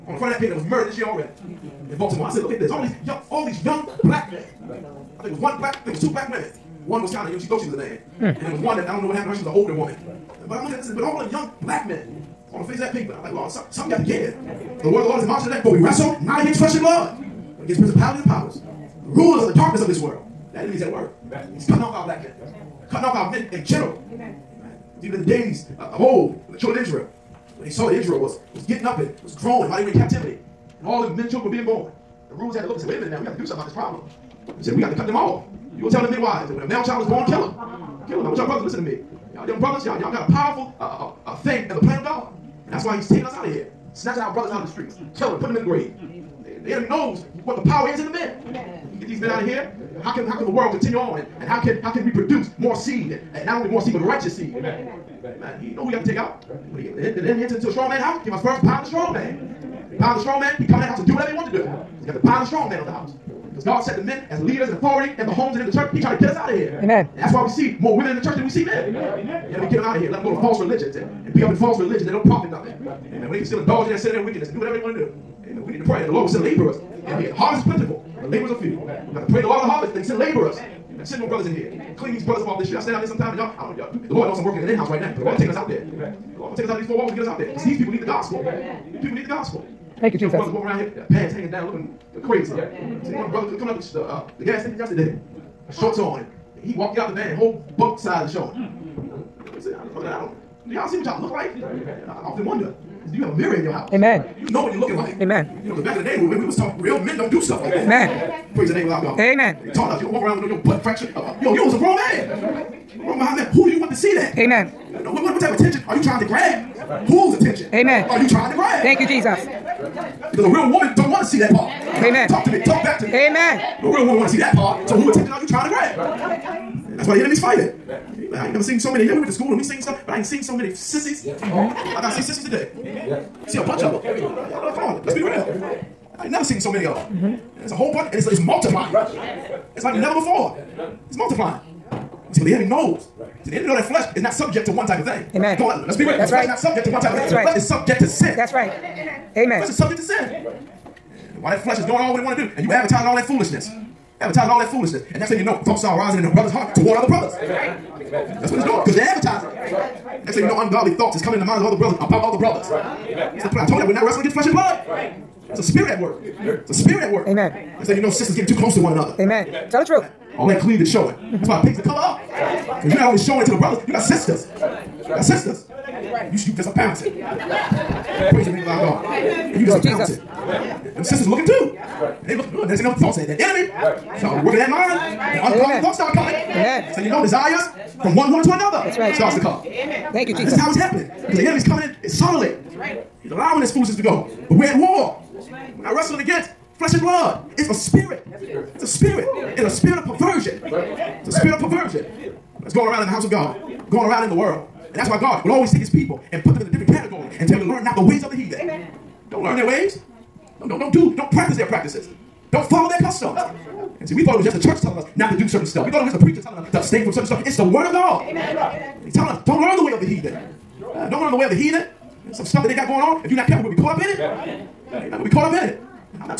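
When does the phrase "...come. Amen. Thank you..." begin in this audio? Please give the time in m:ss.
3:09.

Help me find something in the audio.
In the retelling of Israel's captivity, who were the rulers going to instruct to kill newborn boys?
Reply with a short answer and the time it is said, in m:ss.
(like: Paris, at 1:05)
The midwives, at 0:36.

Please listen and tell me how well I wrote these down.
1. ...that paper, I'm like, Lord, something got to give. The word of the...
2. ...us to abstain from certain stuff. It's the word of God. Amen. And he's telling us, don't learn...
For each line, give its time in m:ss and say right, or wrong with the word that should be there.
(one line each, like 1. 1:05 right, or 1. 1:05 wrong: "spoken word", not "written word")
1. 0:12 right
2. 3:36 right.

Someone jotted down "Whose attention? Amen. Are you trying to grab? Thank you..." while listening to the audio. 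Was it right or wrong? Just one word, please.
right.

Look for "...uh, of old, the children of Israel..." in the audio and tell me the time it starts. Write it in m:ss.
0:25.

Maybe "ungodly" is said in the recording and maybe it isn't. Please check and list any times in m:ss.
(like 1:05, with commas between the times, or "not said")
2:40, 3:05.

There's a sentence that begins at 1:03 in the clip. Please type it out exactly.
Because God set the men as leaders and authority in the homes and in the church.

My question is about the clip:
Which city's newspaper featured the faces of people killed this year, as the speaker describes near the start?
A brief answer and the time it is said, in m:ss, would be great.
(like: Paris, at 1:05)
Baltimore, at 0:01.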